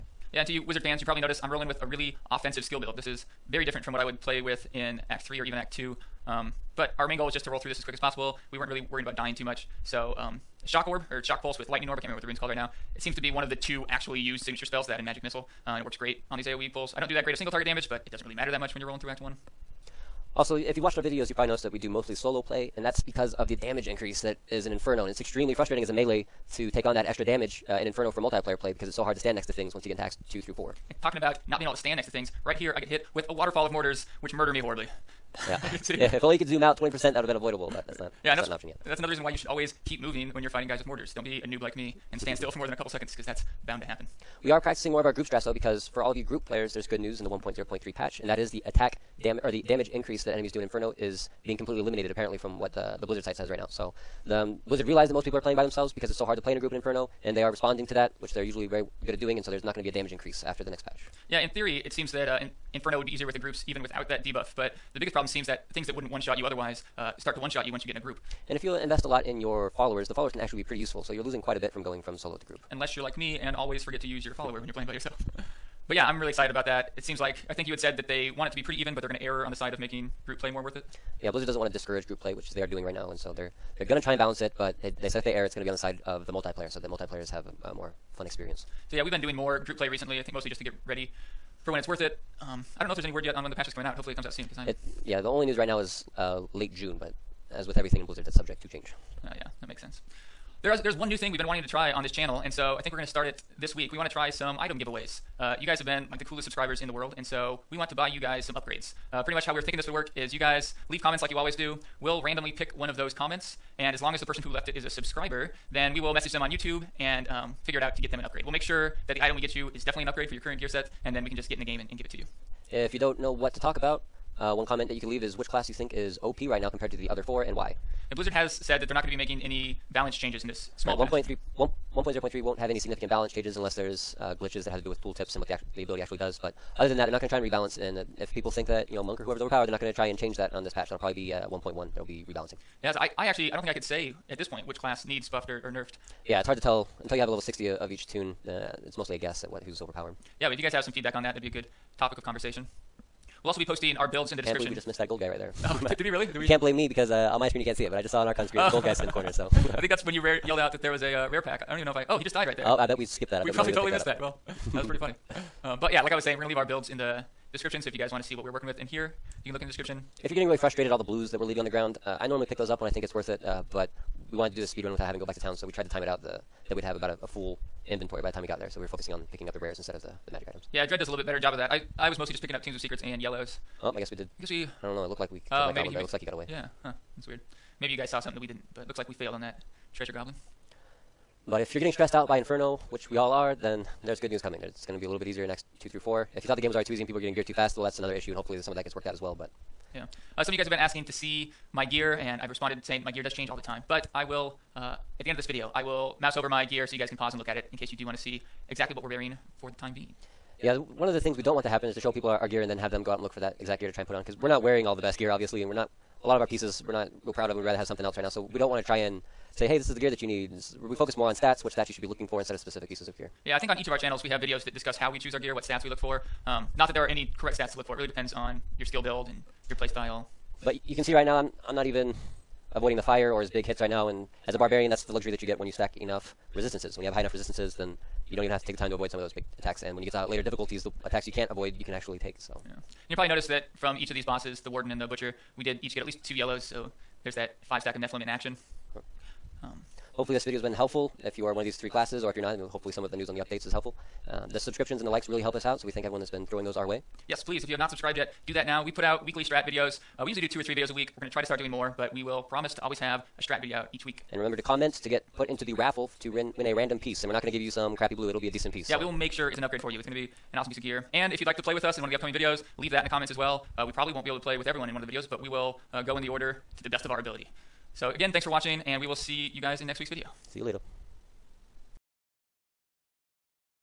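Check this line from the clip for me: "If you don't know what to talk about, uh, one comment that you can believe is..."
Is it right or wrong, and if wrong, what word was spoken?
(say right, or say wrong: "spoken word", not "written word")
wrong: "leave", not "believe".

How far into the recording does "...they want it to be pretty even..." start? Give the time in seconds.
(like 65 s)
78 s.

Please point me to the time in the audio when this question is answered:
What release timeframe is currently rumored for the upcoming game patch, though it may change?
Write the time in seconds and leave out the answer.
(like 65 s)
96 s.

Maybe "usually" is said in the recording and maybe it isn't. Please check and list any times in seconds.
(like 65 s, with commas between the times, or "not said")
58 s, 260 s.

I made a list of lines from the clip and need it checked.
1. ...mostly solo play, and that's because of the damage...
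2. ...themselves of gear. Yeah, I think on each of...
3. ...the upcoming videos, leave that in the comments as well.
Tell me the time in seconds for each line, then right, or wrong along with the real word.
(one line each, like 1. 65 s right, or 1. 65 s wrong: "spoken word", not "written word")
1. 21 s right
2. 222 s wrong: "pieces", not "themselves"
3. 272 s right.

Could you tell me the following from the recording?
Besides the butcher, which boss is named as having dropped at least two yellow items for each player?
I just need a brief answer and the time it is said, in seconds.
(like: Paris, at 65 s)
the warden, at 244 s.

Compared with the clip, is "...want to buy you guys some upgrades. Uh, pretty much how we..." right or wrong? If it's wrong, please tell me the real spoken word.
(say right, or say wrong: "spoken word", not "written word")
right.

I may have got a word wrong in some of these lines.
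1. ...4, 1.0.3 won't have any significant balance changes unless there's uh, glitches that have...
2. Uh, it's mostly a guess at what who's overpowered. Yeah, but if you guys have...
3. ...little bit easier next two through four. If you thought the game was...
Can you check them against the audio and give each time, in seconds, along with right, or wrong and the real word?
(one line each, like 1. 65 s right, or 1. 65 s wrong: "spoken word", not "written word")
1. 131 s wrong: "1", not "4"
2. 148 s right
3. 195 s right.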